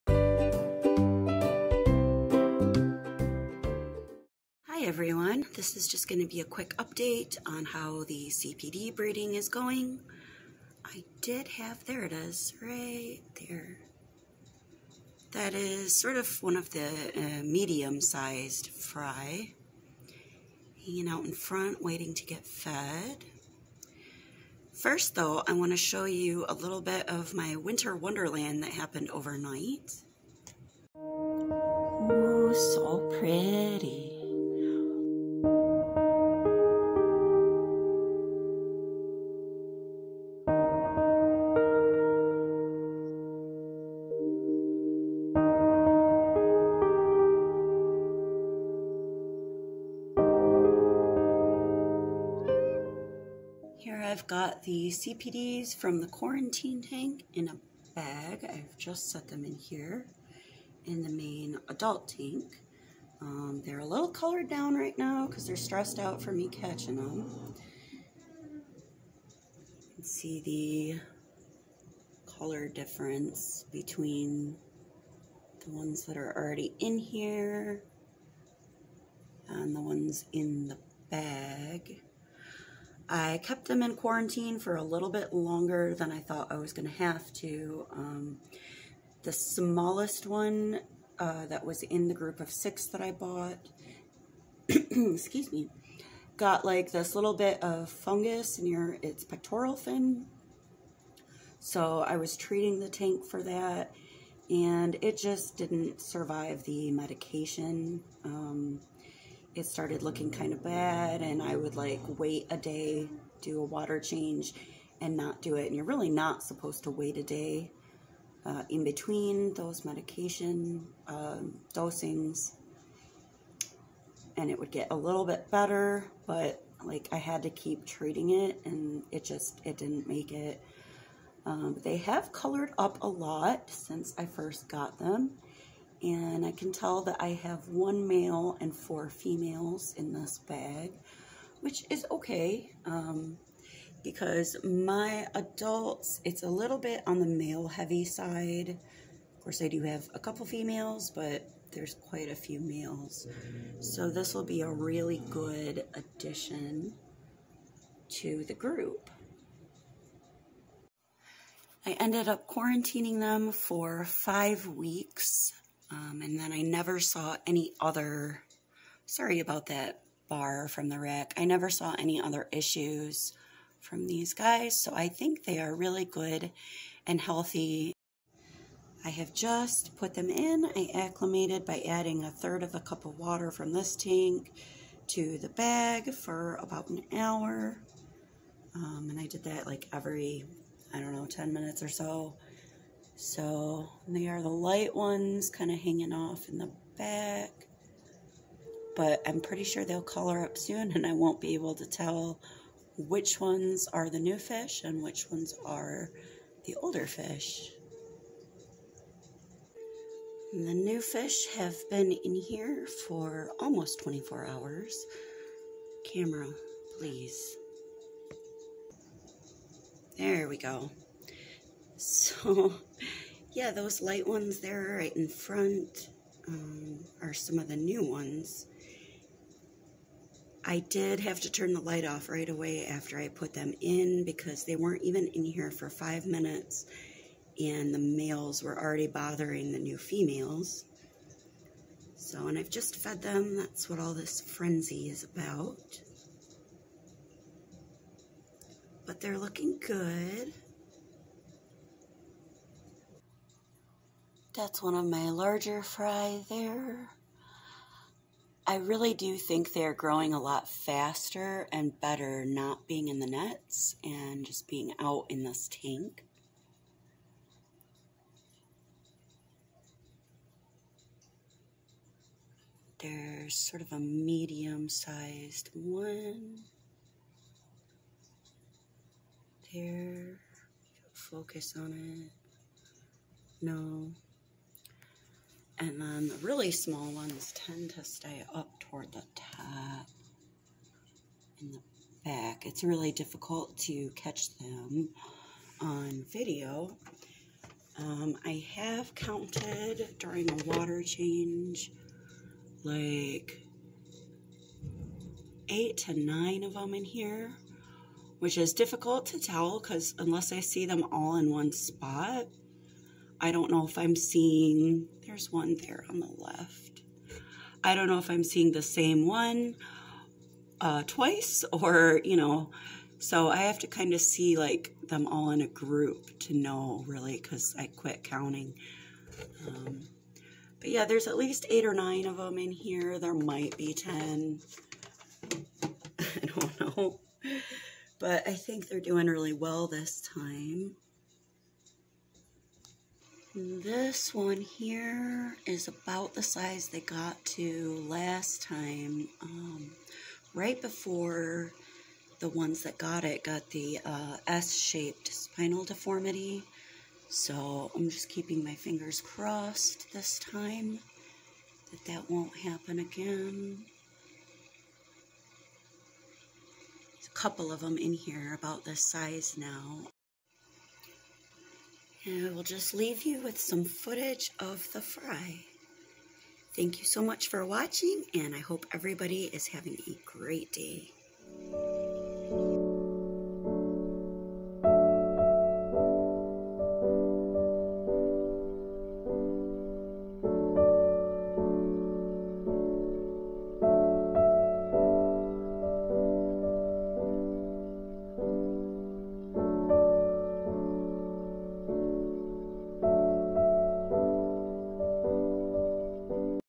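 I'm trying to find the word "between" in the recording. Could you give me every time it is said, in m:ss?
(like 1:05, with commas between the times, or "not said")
1:13, 1:58.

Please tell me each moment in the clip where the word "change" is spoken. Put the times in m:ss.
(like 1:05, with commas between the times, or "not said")
1:53, 5:01.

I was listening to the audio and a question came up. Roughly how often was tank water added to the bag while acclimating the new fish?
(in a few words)
10 minutes.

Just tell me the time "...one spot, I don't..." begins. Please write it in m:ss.
5:11.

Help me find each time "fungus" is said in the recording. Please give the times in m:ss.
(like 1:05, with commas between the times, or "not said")
1:37.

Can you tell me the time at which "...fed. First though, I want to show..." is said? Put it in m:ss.
0:22.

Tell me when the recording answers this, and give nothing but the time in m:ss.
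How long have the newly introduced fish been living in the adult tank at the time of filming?
3:33.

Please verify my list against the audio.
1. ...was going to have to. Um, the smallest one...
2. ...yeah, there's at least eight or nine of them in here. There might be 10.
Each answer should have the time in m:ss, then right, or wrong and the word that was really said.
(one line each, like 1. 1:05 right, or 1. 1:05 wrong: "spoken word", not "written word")
1. 1:26 right
2. 5:30 right.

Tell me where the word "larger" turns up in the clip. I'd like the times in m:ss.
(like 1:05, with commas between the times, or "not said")
4:15.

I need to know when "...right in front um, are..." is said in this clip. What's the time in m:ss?
3:44.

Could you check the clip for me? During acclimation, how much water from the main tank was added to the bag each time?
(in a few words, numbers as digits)
a third of a cup.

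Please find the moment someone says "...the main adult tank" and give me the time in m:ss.
1:01.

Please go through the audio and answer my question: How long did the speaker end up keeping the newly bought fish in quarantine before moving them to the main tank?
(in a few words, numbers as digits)
5 weeks.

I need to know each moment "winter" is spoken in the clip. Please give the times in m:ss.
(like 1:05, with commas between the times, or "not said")
0:27.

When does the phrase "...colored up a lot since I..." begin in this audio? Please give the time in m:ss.
2:12.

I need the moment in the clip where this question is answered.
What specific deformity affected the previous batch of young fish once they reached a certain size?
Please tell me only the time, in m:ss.
5:54.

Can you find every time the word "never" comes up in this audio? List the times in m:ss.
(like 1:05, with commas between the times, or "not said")
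2:46, 2:51.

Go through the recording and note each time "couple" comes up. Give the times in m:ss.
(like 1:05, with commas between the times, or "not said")
2:30, 6:07.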